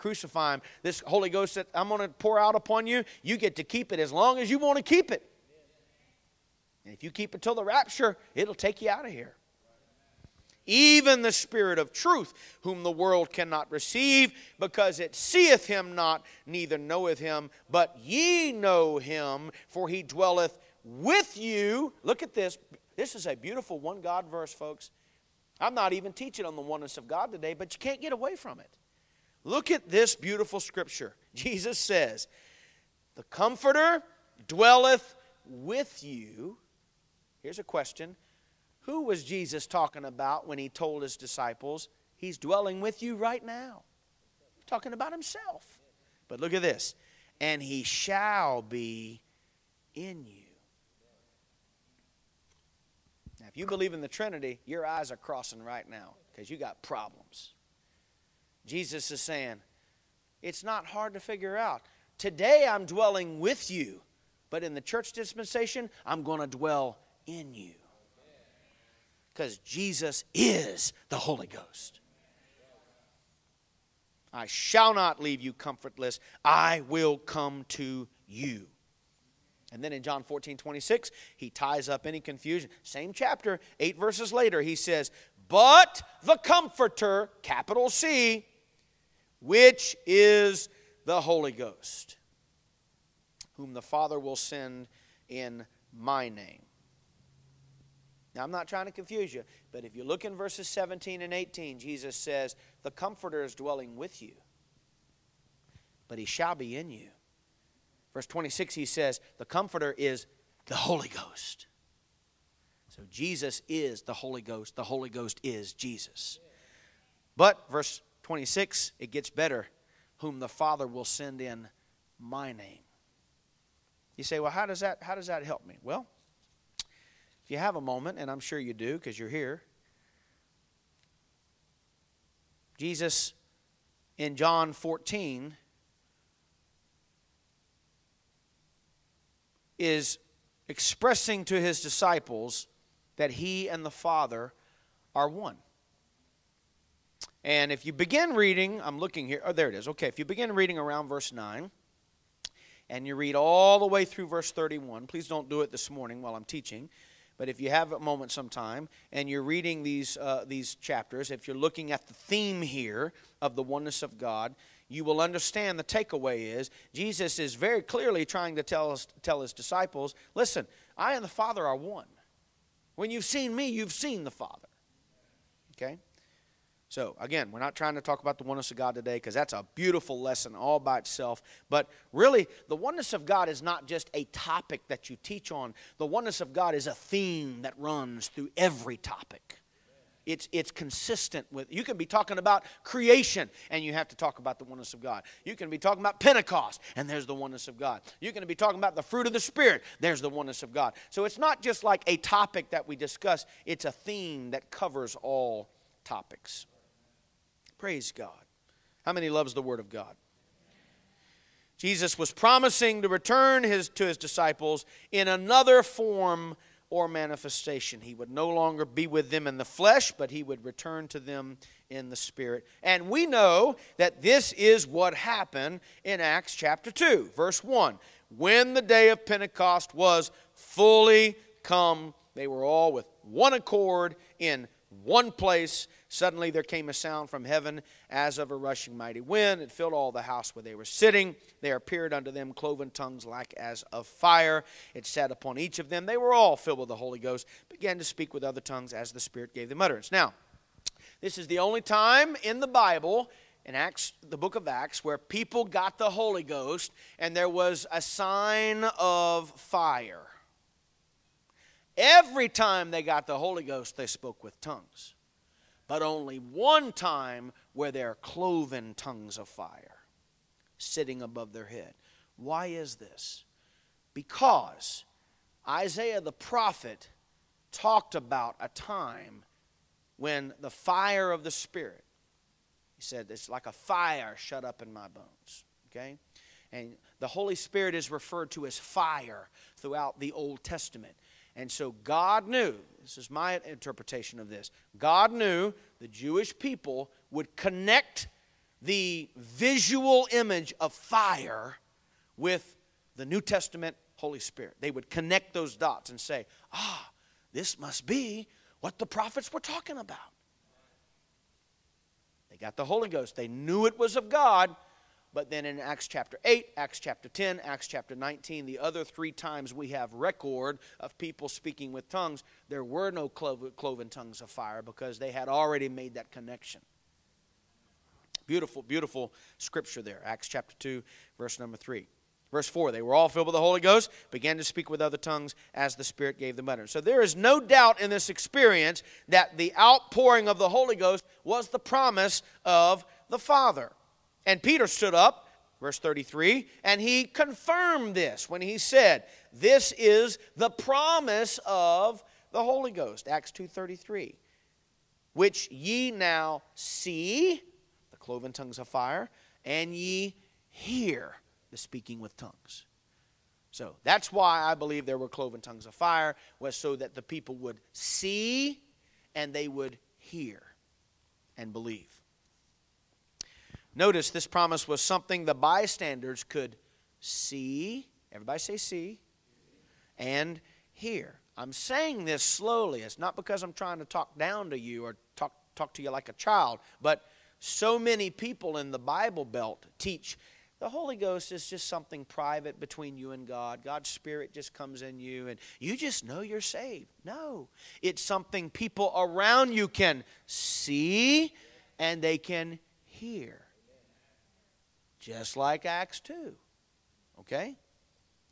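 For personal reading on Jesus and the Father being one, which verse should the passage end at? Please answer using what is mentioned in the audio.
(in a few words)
Verse 31.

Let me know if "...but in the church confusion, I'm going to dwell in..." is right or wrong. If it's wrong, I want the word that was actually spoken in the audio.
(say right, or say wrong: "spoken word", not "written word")
wrong: "dispensation", not "confusion".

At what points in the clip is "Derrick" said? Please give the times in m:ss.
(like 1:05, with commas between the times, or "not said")
not said.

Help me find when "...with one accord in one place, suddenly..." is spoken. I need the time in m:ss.
3:52.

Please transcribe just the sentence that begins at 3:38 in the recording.
He would no longer be with them in the flesh, but he would return to them in the spirit.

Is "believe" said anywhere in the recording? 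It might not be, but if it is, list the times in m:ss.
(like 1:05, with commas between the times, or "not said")
0:53, 6:04, 6:11.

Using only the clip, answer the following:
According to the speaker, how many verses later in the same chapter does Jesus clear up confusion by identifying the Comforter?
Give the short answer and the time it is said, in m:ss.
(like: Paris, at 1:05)
8, at 1:23.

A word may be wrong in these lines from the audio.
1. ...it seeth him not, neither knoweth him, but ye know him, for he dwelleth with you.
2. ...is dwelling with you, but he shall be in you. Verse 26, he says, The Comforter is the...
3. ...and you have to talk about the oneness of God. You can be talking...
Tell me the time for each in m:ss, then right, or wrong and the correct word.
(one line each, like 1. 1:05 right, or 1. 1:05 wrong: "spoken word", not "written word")
1. 0:14 right
2. 1:43 right
3. 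3:13 right.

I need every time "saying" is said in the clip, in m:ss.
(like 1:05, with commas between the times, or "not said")
0:59, 6:21.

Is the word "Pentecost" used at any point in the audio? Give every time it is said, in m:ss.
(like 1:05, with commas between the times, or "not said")
3:16, 3:49.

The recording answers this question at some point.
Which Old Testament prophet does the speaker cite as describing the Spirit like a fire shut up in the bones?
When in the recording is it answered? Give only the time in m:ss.
4:35.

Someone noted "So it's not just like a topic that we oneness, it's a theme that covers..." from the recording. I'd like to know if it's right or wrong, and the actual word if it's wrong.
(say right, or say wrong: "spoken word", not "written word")
wrong: "discuss", not "oneness".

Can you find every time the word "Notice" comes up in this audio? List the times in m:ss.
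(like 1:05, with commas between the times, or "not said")
6:13.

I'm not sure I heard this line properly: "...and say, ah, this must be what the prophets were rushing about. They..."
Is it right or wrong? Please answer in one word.
wrong.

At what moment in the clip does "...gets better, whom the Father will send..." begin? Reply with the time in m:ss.
1:59.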